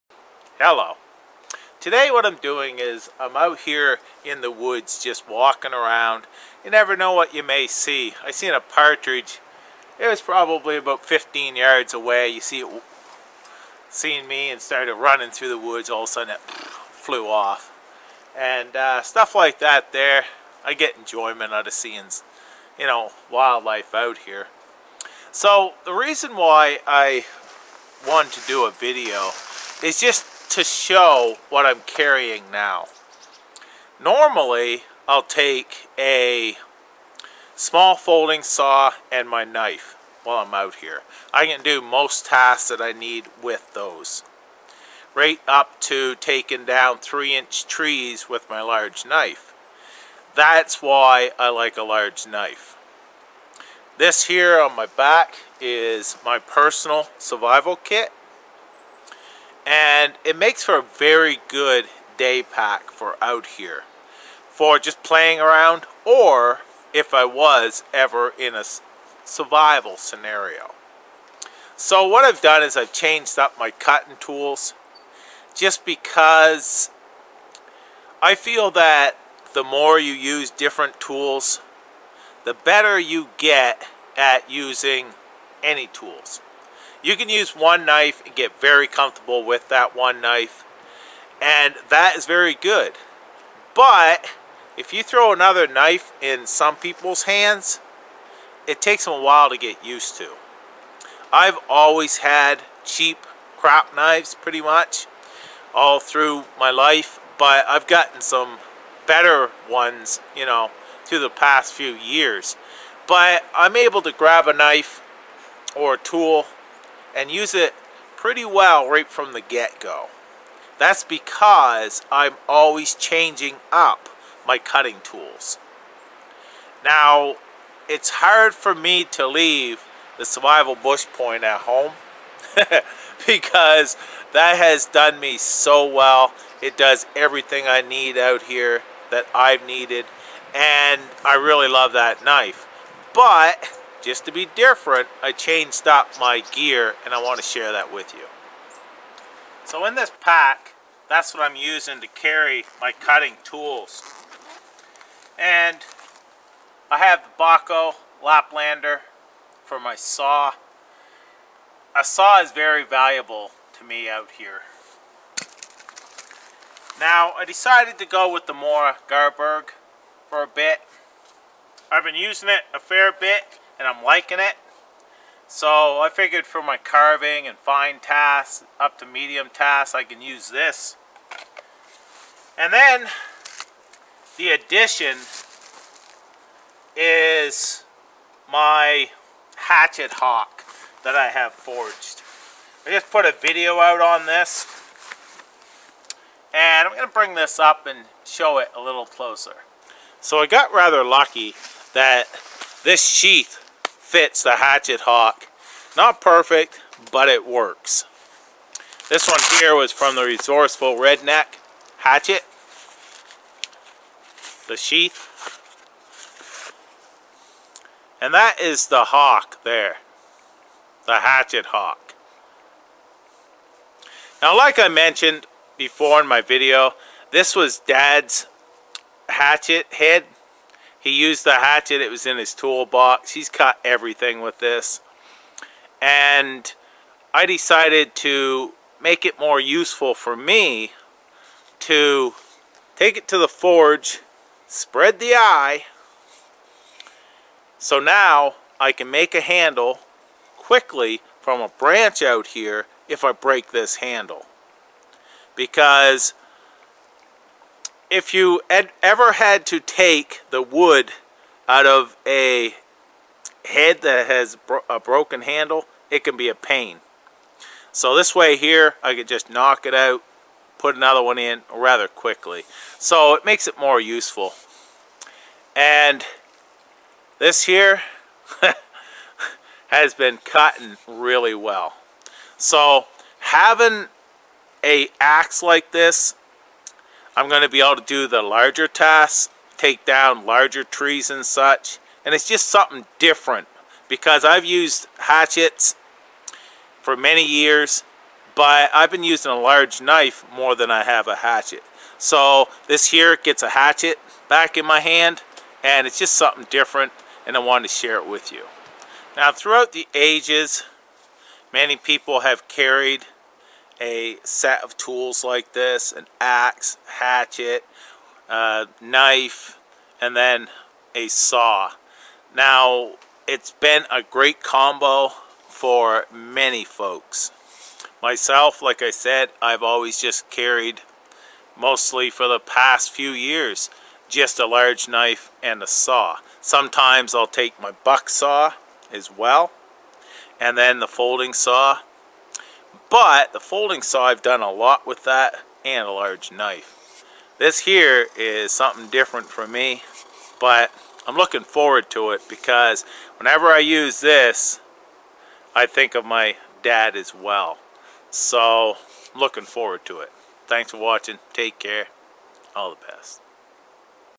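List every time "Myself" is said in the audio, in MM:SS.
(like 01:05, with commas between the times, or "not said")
05:28.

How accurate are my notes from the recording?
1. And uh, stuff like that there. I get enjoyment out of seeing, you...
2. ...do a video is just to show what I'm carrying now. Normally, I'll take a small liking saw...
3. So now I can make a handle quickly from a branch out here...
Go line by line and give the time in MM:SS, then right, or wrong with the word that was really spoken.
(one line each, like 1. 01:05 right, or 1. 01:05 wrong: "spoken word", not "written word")
1. 00:18 right
2. 00:28 wrong: "folding", not "liking"
3. 04:07 right.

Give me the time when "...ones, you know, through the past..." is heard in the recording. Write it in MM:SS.
01:49.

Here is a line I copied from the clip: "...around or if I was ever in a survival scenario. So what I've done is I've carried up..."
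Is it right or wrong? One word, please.
wrong.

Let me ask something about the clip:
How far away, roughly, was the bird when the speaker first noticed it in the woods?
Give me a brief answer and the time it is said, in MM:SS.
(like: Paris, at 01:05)
15 yards, at 00:11.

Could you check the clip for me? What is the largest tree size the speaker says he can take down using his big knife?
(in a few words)
3 inch.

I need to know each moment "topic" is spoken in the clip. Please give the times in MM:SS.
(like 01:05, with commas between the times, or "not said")
not said.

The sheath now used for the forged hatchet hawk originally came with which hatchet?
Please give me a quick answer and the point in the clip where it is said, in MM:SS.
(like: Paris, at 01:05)
Resourceful Redneck Hatchet, at 03:30.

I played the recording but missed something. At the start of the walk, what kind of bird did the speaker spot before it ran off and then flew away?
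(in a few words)
partridge.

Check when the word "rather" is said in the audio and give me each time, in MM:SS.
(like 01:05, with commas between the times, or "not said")
03:20, 04:31.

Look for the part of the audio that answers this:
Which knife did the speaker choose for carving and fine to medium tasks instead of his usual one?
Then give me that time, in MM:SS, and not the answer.
02:48.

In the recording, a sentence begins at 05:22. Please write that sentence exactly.
Now, it's been a great combo for many folks.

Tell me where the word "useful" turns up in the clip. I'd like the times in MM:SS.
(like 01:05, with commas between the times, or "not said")
03:59, 04:34.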